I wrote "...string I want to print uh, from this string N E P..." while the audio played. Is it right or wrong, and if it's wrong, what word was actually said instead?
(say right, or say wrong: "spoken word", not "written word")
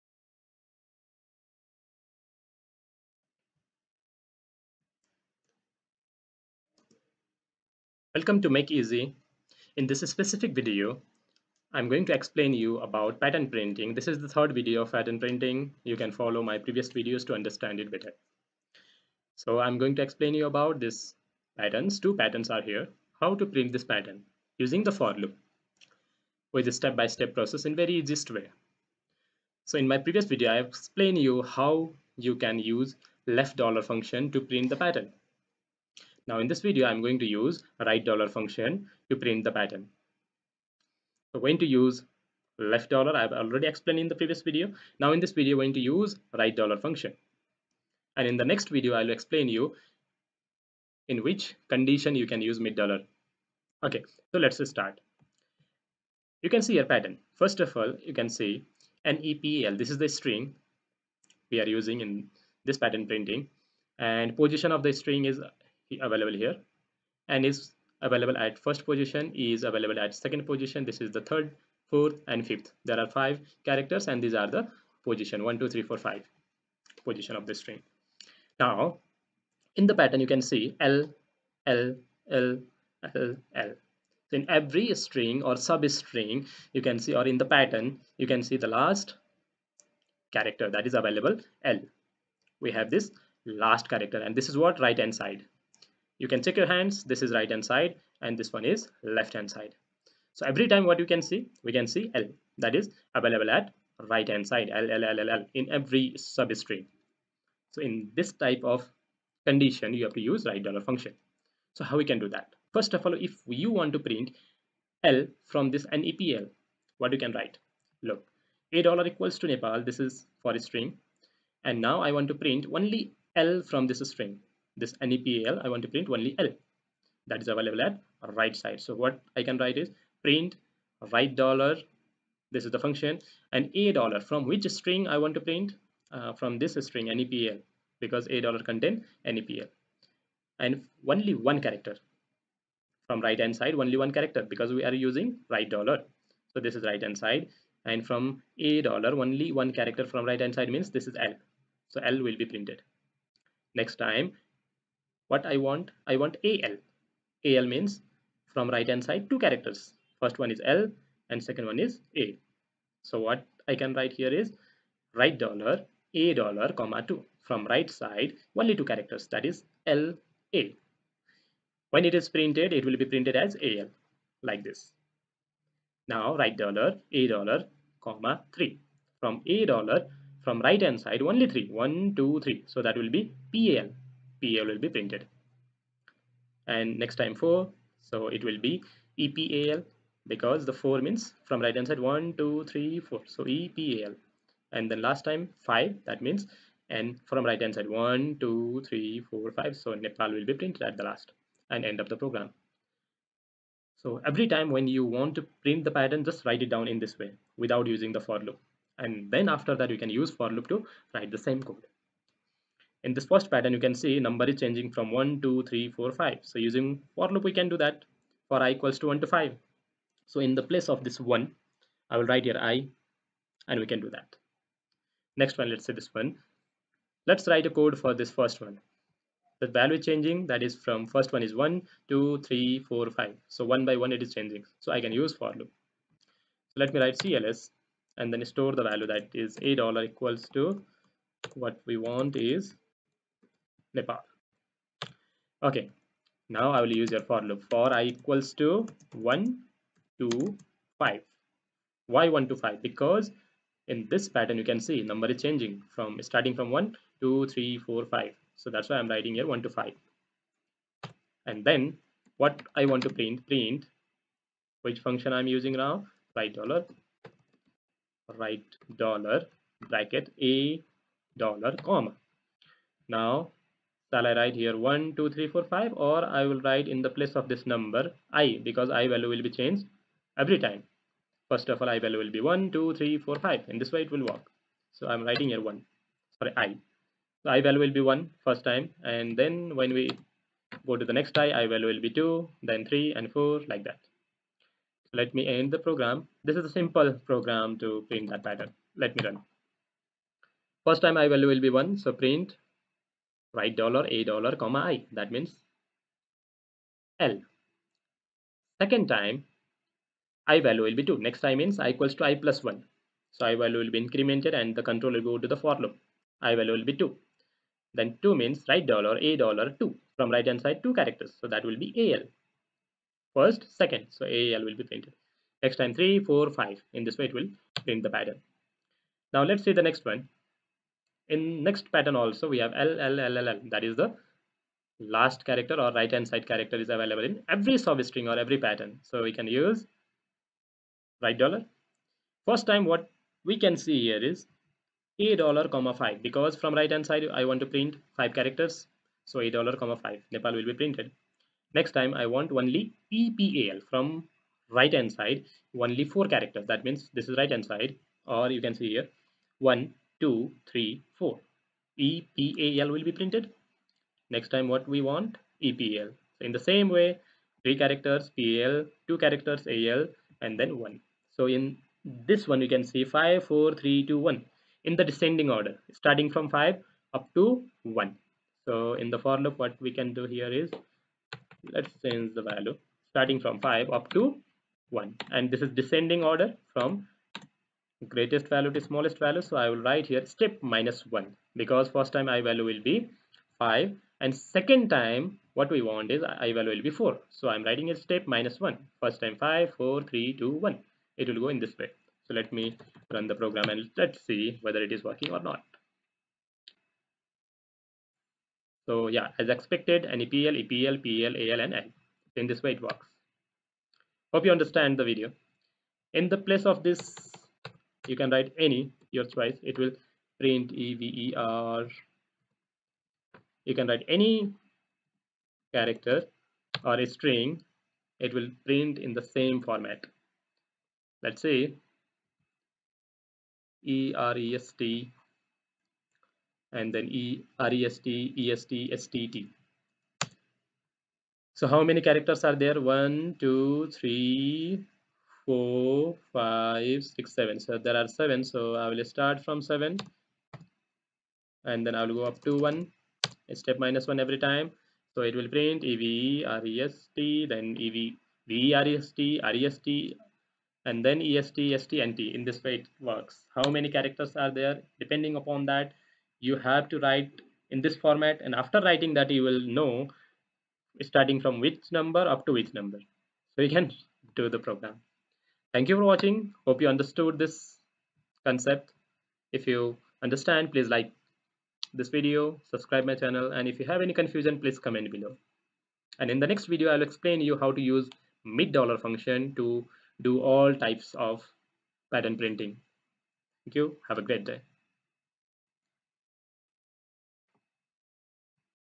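right.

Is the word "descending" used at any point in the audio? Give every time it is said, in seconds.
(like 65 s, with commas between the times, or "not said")
375 s, 385 s.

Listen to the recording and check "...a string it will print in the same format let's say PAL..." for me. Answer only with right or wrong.
wrong.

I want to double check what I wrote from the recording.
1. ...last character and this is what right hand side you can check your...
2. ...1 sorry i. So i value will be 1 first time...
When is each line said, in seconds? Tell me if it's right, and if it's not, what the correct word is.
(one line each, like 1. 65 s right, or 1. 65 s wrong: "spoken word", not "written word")
1. 93 s right
2. 285 s right.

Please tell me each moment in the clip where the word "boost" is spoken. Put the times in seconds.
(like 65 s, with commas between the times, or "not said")
not said.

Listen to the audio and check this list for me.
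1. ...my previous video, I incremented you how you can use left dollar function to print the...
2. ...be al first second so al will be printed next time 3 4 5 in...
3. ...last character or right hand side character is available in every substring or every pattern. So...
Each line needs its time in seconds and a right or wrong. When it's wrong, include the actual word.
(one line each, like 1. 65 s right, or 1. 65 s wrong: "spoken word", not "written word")
1. 29 s wrong: "explained", not "incremented"
2. 321 s right
3. 334 s right.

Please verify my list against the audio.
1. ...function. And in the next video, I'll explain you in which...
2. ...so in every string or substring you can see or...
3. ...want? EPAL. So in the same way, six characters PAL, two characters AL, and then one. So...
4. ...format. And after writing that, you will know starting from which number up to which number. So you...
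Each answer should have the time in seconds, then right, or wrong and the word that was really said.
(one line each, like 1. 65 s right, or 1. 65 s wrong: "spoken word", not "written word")
1. 46 s right
2. 84 s right
3. 365 s wrong: "three", not "six"
4. 467 s right.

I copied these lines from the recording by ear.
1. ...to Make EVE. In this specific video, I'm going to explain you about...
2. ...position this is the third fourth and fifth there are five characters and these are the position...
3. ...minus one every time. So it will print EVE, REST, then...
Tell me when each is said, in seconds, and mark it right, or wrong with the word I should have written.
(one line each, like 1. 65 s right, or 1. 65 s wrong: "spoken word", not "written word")
1. 8 s wrong: "Easy", not "EVE"
2. 70 s right
3. 453 s right.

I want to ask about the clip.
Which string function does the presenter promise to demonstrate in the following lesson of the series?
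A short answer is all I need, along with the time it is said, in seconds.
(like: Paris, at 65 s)
mid dollar, at 488 s.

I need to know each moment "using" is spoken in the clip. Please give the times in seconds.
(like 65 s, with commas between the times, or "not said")
24 s, 61 s, 144 s, 207 s, 216 s, 265 s.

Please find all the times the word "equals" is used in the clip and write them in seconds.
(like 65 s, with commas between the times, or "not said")
119 s, 218 s, 240 s, 248 s, 311 s.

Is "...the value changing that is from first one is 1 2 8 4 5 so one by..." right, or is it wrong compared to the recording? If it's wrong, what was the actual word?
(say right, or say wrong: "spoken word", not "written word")
wrong: "3", not "8".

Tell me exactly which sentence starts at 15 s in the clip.
You can follow my previous videos to understand it better.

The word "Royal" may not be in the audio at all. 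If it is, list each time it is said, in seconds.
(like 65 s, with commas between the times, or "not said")
not said.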